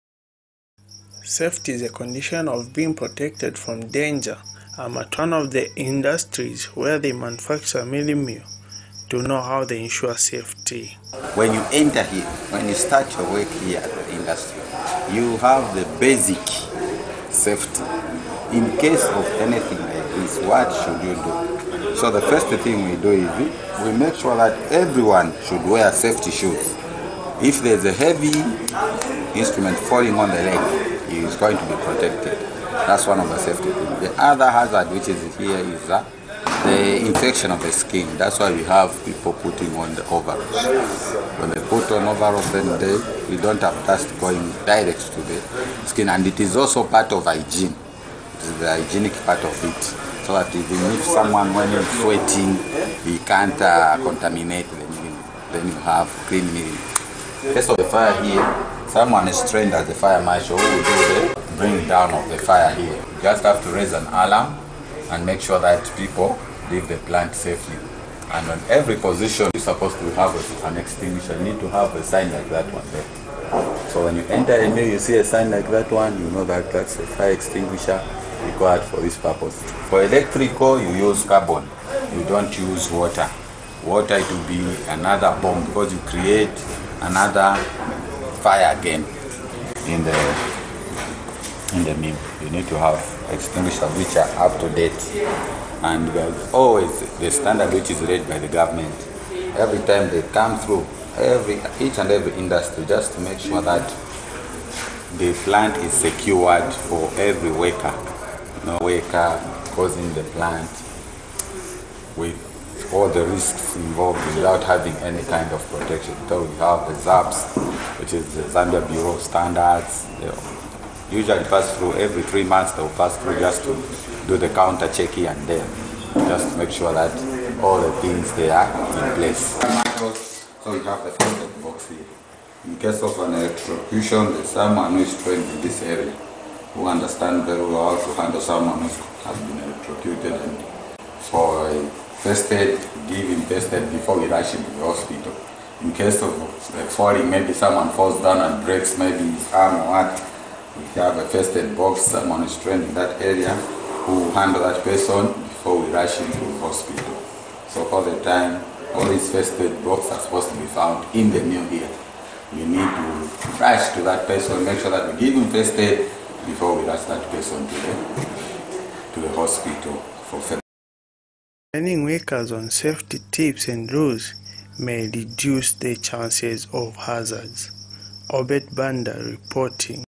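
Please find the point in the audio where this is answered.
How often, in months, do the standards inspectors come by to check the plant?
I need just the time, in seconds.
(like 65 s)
122 s.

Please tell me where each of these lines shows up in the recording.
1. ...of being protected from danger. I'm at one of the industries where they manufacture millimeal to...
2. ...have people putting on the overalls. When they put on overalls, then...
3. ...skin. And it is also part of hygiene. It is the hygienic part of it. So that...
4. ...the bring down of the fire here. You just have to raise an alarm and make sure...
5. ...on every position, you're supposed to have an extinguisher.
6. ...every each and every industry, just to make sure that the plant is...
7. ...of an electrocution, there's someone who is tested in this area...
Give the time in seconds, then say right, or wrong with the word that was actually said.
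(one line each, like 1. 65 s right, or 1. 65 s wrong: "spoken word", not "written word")
1. 2 s right
2. 38 s right
3. 45 s right
4. 61 s right
5. 68 s right
6. 101 s right
7. 133 s wrong: "trained", not "tested".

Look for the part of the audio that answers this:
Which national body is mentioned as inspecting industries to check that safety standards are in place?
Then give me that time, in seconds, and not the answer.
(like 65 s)
118 s.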